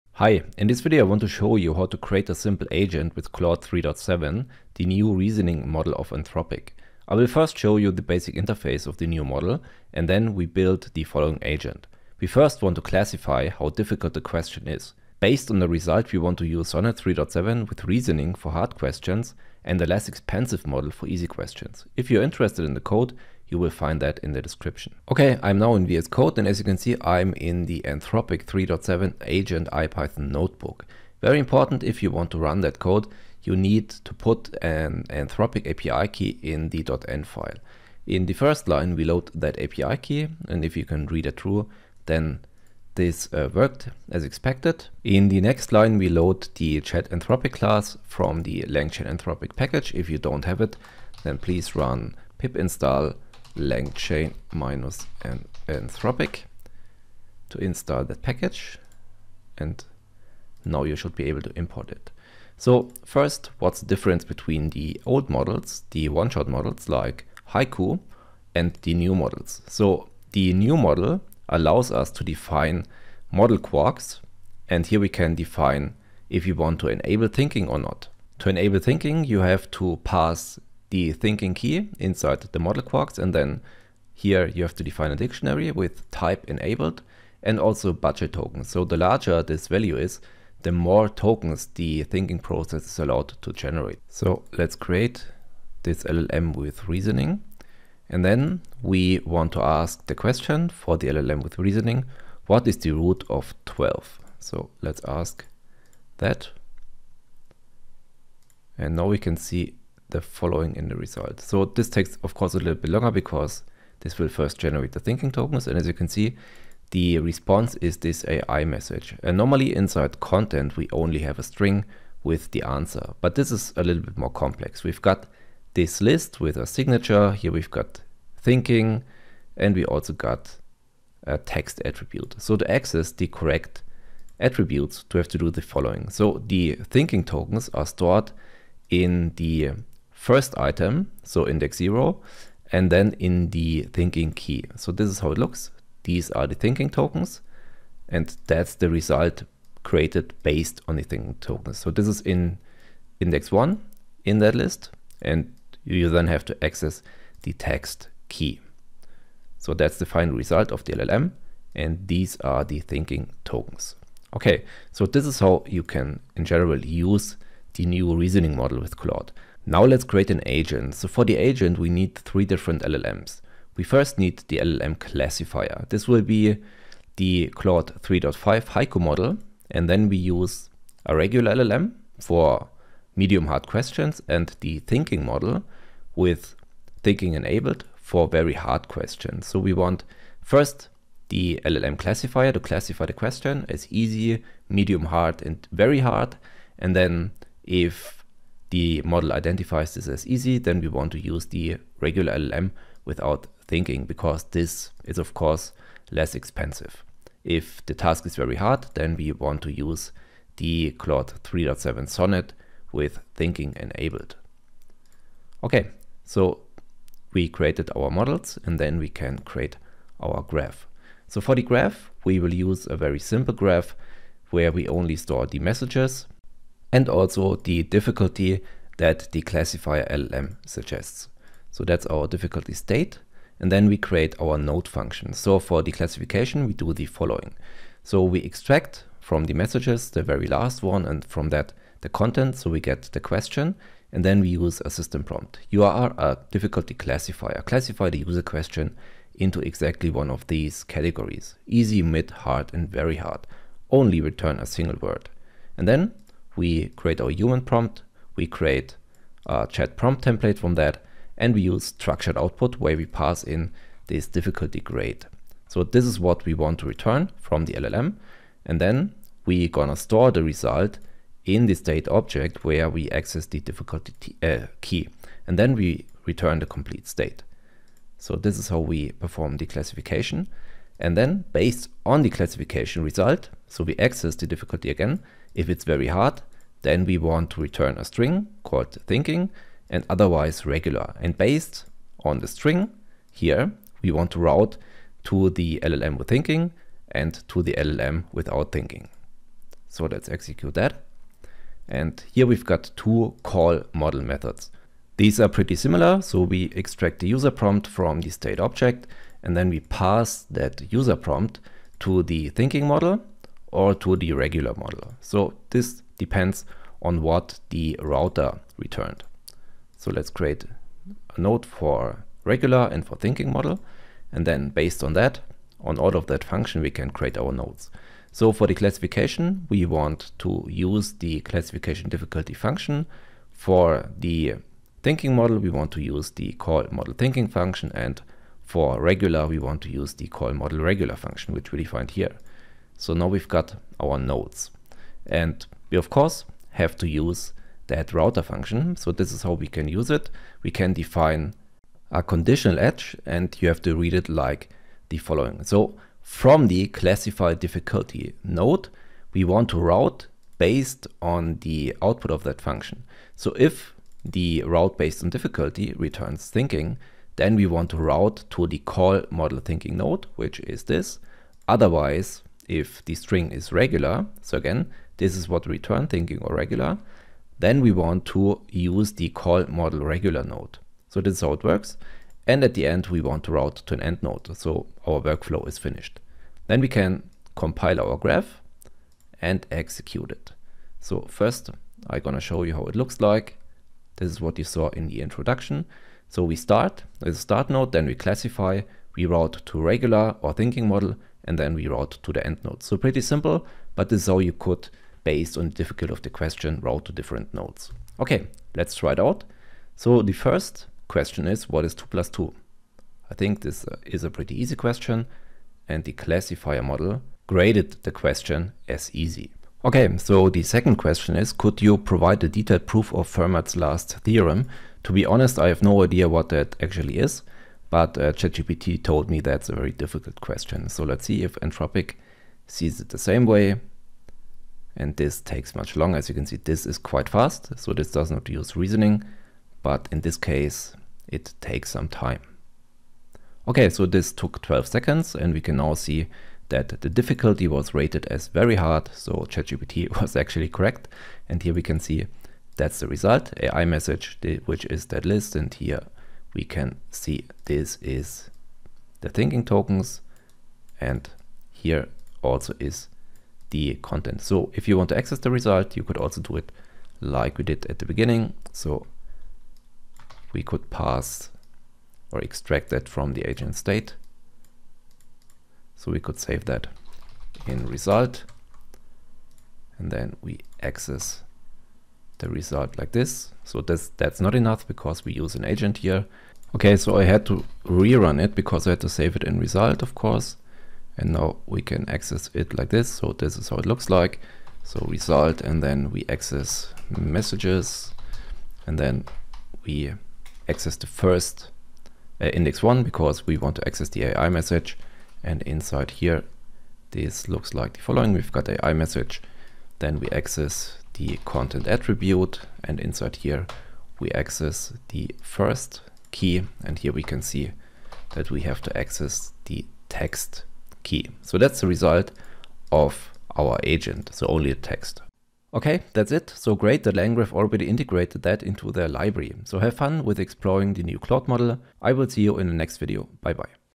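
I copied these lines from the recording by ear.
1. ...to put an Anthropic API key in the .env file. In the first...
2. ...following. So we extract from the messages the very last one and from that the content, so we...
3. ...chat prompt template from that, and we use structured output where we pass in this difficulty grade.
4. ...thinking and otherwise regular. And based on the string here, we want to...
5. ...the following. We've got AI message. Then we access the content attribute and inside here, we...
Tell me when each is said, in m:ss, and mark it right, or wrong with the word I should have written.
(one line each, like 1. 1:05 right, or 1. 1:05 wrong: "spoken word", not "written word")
1. 0:34 right
2. 3:57 right
3. 4:19 right
4. 4:49 right
5. 8:27 right.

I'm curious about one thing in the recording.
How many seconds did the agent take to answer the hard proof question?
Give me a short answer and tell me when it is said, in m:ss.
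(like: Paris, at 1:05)
12, at 7:24.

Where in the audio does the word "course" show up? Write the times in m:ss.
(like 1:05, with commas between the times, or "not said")
1:52, 3:25, 5:46, 8:10.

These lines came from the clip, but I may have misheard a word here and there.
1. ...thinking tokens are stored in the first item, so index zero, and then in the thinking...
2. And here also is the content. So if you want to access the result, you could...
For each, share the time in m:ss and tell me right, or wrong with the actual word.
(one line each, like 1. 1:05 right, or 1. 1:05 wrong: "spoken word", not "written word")
1. 2:16 right
2. 7:40 right.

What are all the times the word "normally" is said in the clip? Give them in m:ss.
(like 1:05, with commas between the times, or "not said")
1:59.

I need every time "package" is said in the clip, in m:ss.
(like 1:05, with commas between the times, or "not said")
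0:49, 0:58.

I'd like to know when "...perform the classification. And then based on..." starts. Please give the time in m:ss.
4:39.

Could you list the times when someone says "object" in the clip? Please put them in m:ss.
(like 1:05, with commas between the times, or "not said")
4:32, 5:08.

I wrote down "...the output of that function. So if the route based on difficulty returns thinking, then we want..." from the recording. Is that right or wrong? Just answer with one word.
right.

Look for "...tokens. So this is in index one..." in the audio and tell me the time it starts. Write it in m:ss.
2:31.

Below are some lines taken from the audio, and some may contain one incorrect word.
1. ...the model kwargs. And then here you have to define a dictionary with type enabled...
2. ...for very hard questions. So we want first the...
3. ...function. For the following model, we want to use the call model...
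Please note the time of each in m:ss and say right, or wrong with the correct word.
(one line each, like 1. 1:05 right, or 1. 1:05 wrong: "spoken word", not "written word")
1. 1:22 right
2. 3:07 right
3. 5:32 wrong: "thinking", not "following".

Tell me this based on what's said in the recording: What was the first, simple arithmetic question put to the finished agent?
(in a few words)
What is 2 plus 2?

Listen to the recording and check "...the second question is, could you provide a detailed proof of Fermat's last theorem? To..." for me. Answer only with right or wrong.
right.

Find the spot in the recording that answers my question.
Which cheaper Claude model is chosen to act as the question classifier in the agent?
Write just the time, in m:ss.
2:57.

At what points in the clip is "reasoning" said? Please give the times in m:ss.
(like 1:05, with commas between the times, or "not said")
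0:05, 0:17, 1:36, 1:41, 2:48, 7:18.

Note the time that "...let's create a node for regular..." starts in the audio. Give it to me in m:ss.
5:20.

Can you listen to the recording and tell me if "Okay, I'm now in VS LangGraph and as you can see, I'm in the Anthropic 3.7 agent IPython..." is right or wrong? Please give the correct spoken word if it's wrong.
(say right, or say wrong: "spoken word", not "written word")
wrong: "Code", not "LangGraph".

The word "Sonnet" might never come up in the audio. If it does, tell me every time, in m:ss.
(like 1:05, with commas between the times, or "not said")
0:16, 3:32.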